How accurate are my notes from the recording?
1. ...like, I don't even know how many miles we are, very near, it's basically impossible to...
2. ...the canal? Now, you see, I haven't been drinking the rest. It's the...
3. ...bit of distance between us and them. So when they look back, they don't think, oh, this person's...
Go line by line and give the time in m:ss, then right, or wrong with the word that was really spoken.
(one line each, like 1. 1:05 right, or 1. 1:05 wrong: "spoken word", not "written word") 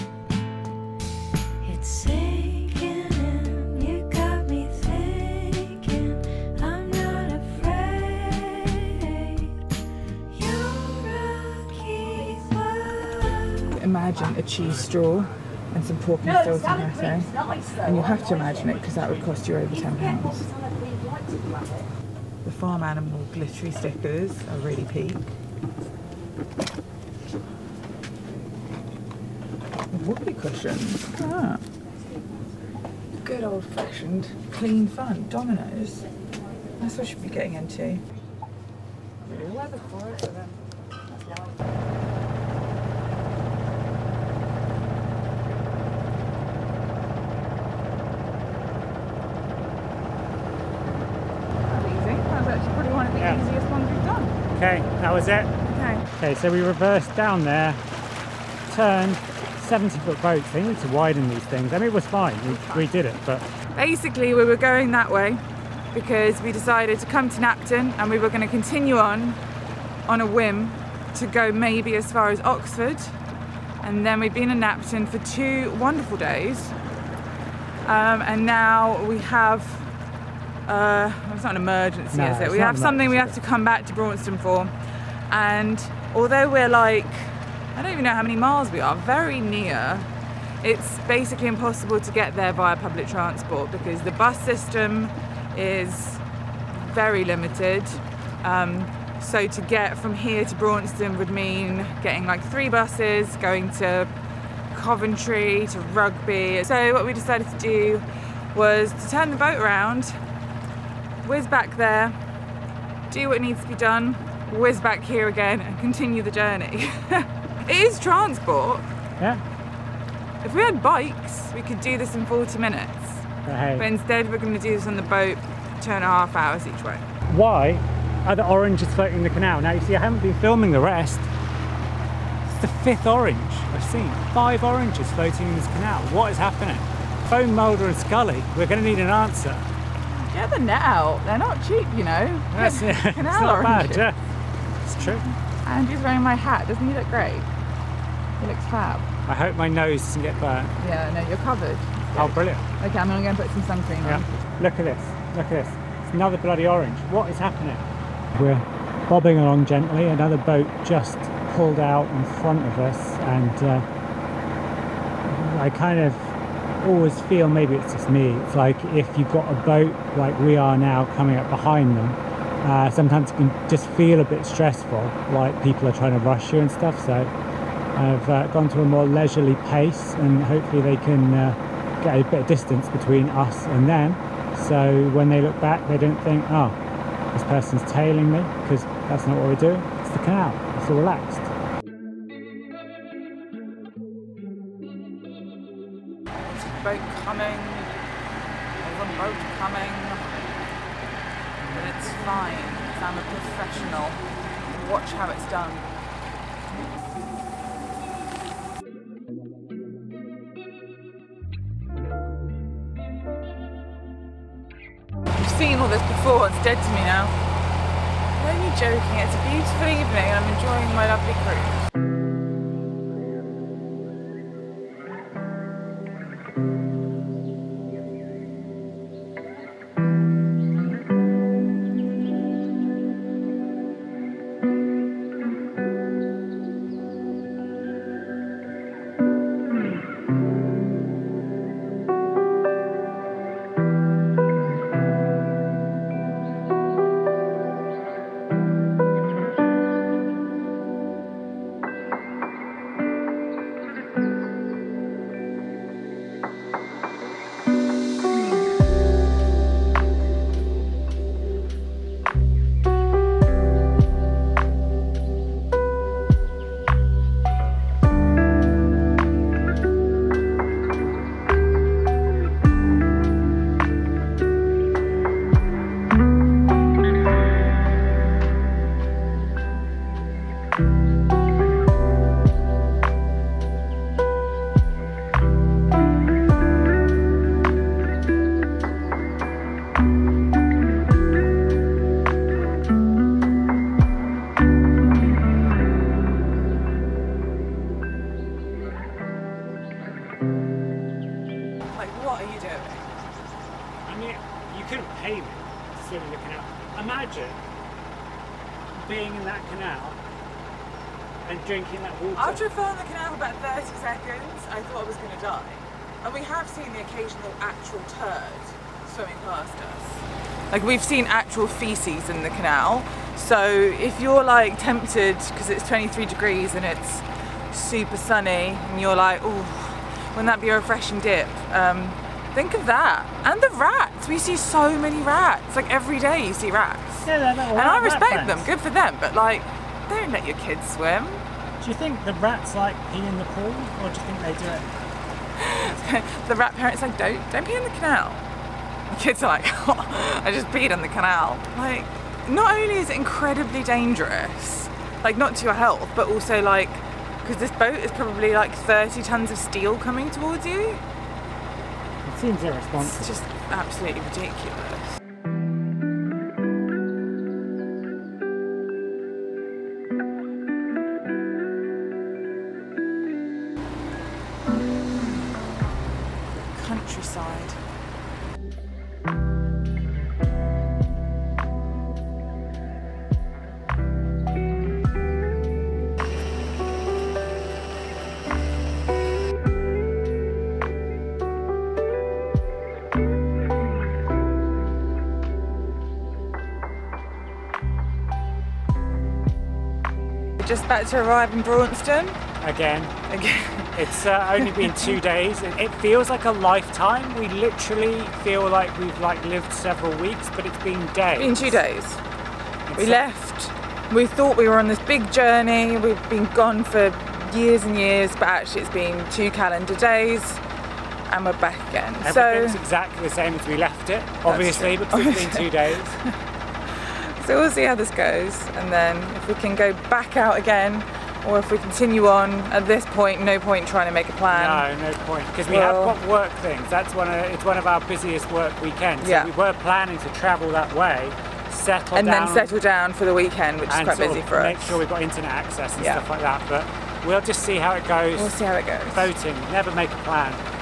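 1. 1:26 right
2. 2:09 wrong: "filming", not "drinking"
3. 3:02 right.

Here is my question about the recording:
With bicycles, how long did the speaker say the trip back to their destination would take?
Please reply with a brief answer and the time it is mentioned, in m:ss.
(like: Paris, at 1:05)
40 minutes, at 2:02.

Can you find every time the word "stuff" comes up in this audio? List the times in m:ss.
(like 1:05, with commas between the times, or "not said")
2:56, 7:26.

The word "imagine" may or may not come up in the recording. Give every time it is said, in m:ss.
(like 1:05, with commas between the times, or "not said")
0:13, 0:18.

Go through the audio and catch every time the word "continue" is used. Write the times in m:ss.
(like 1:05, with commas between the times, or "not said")
1:08, 1:55, 7:11.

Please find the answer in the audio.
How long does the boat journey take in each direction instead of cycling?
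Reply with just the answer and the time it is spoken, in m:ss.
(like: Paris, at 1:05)
2 and a half hours, at 2:05.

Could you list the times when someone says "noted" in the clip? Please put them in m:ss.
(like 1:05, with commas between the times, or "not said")
not said.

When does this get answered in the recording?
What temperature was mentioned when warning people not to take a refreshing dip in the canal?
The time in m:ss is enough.
5:25.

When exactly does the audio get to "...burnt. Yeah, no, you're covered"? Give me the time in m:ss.
2:30.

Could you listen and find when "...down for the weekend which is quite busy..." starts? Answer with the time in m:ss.
7:22.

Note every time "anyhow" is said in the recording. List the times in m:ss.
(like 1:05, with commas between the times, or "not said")
not said.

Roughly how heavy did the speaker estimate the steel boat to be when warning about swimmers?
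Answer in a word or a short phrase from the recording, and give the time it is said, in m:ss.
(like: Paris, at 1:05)
30 tons, at 5:58.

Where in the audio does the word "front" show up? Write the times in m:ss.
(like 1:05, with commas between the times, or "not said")
2:42.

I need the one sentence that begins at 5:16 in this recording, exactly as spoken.
And we have seen the occasional actual turd swimming past us.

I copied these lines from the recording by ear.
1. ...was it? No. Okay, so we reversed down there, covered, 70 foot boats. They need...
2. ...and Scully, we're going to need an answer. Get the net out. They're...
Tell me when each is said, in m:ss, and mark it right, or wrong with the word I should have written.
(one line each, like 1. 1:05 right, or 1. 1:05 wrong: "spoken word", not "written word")
1. 0:55 wrong: "turned", not "covered"
2. 2:17 right.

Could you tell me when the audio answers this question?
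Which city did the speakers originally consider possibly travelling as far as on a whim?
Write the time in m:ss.
1:12.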